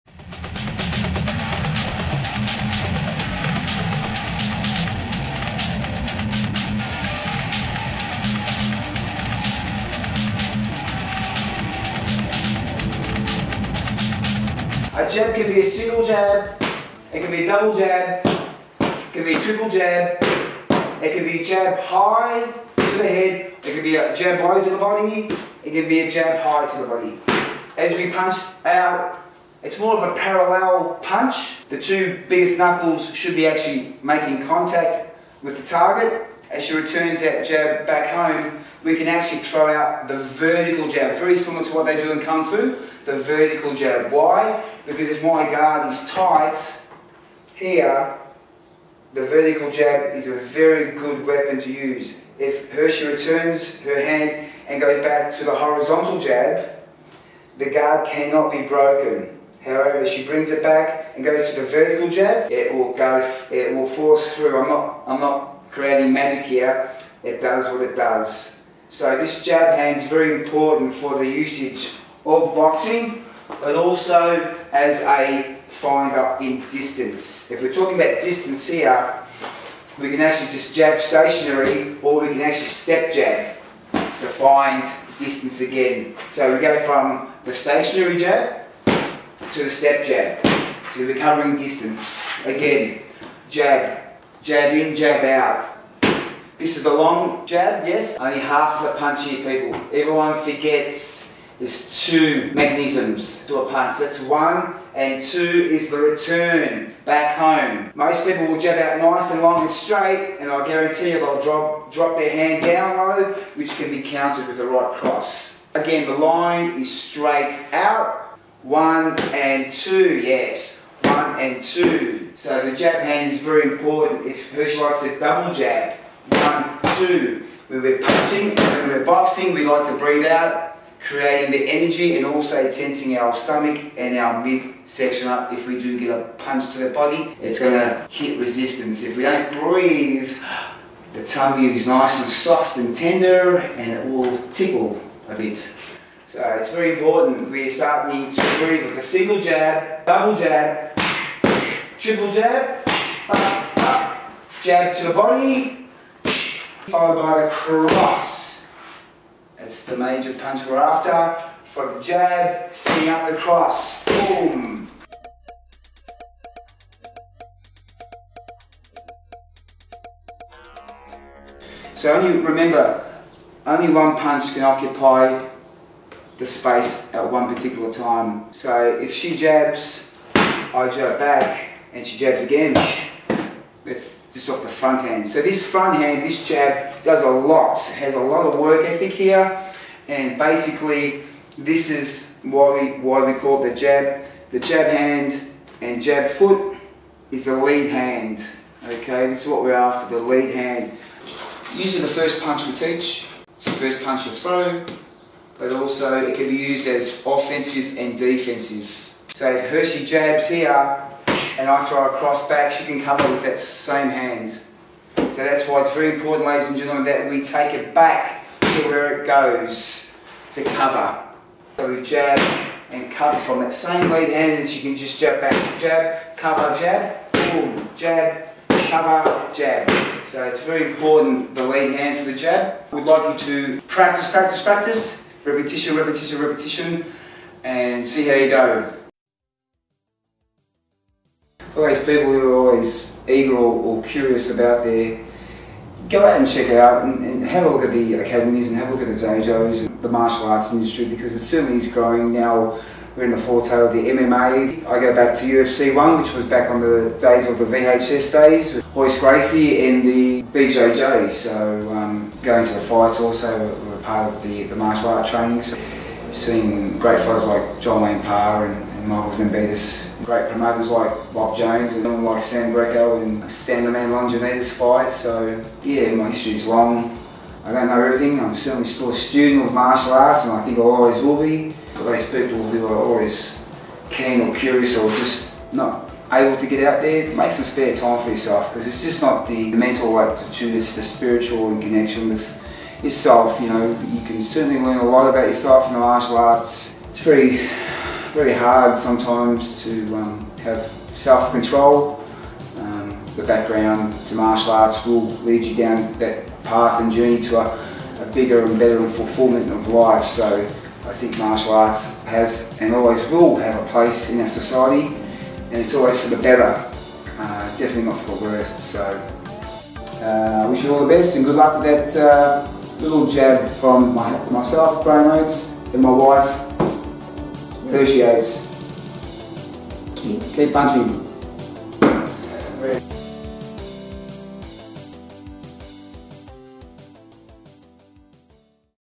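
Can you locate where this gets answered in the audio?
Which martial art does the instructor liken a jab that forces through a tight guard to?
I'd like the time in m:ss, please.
0:42.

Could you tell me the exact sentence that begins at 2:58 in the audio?
So if she jabs, I jab back, and she jabs again.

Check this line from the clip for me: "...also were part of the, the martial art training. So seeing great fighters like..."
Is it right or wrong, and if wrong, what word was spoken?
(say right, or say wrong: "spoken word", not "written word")
right.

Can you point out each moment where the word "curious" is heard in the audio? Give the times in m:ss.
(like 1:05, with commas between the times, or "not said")
4:04, 4:44.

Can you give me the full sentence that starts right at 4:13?
We're in the foretail of the MMA.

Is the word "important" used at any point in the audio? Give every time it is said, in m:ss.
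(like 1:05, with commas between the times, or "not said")
1:10, 2:03, 2:26, 3:36, 3:50.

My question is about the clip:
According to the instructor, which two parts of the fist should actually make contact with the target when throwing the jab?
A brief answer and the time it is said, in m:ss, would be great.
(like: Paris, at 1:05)
The two biggest knuckles, at 0:31.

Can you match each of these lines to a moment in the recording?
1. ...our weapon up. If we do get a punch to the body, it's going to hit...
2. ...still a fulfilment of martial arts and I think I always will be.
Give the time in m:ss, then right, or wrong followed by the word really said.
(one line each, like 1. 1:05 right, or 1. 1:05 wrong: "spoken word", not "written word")
1. 2:14 wrong: "midsection", not "weapon"
2. 4:38 wrong: "student", not "fulfilment".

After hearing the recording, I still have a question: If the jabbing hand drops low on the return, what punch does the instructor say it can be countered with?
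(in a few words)
A right cross.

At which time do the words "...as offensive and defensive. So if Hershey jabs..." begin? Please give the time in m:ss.
3:26.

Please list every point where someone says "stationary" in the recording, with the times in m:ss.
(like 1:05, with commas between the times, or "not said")
1:20, 1:27.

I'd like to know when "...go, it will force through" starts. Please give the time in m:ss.
1:02.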